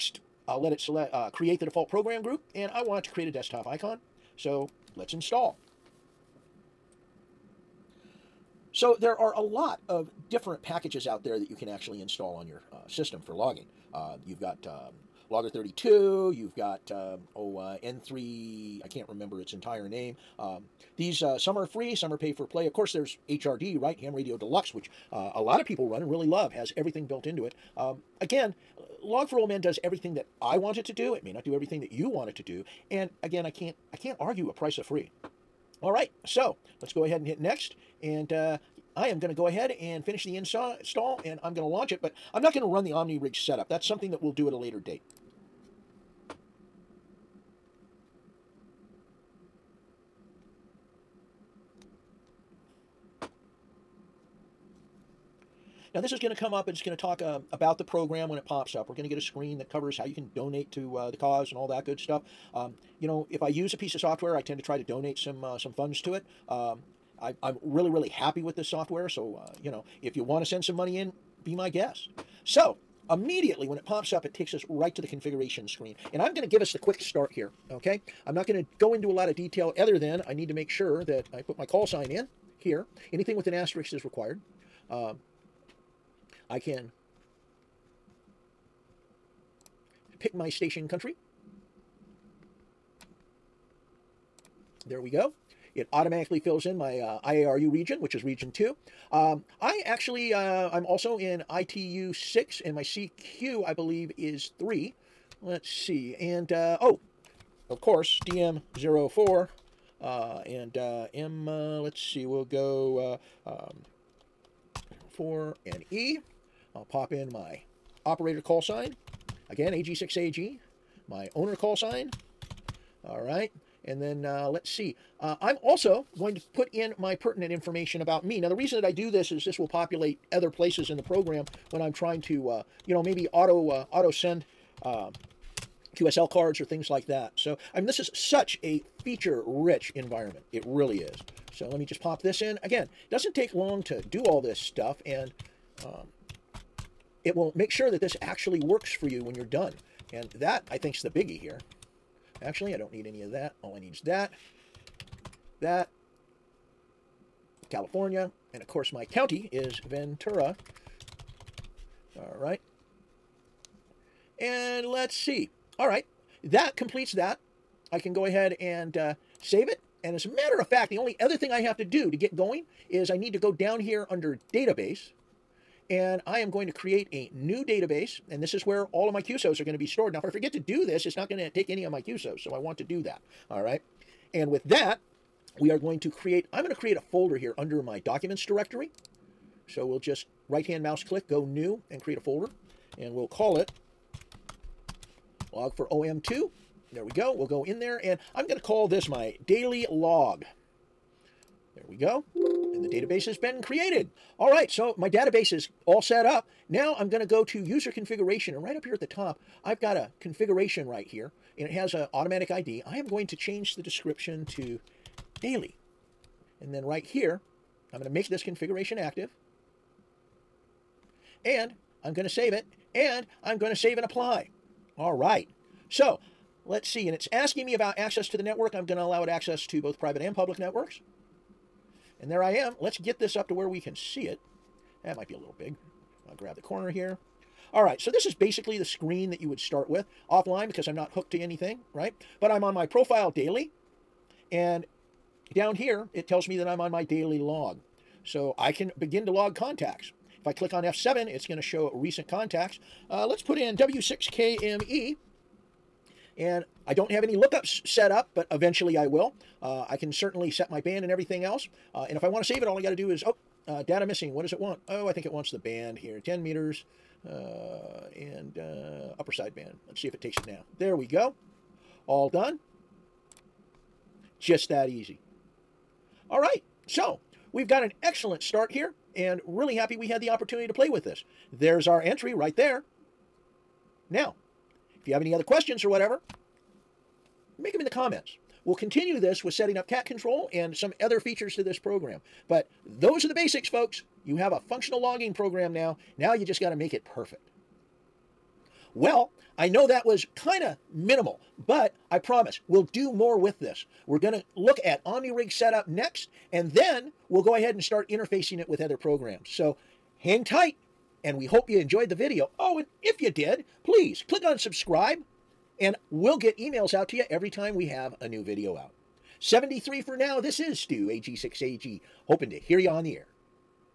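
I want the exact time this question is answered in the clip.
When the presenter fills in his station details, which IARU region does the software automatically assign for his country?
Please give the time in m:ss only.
1:38.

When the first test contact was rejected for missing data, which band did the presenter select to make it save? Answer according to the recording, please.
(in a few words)
10 meters.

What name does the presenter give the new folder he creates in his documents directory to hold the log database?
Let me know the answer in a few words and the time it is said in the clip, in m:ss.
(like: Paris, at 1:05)
log for OM2, at 3:15.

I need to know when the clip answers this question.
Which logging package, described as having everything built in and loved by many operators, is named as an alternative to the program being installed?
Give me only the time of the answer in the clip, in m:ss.
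0:23.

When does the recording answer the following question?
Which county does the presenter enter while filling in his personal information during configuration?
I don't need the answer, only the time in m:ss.
2:39.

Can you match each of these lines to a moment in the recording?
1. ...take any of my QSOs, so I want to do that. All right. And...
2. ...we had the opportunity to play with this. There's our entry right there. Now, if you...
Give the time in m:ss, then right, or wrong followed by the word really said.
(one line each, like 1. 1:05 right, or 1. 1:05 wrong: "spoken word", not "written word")
1. 3:01 right
2. 4:39 right.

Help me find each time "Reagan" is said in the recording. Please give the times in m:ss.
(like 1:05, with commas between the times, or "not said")
not said.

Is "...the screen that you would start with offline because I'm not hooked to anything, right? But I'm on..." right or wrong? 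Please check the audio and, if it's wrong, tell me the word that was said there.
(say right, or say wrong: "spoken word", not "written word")
right.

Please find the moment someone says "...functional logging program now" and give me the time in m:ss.
4:54.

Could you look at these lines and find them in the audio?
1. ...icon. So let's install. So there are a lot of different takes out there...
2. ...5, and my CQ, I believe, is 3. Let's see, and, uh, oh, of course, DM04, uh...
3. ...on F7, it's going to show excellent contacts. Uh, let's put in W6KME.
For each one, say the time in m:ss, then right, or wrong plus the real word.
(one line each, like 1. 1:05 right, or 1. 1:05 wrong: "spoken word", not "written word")
1. 0:03 wrong: "packages", not "takes"
2. 1:42 wrong: "6", not "5"
3. 4:10 wrong: "recent", not "excellent".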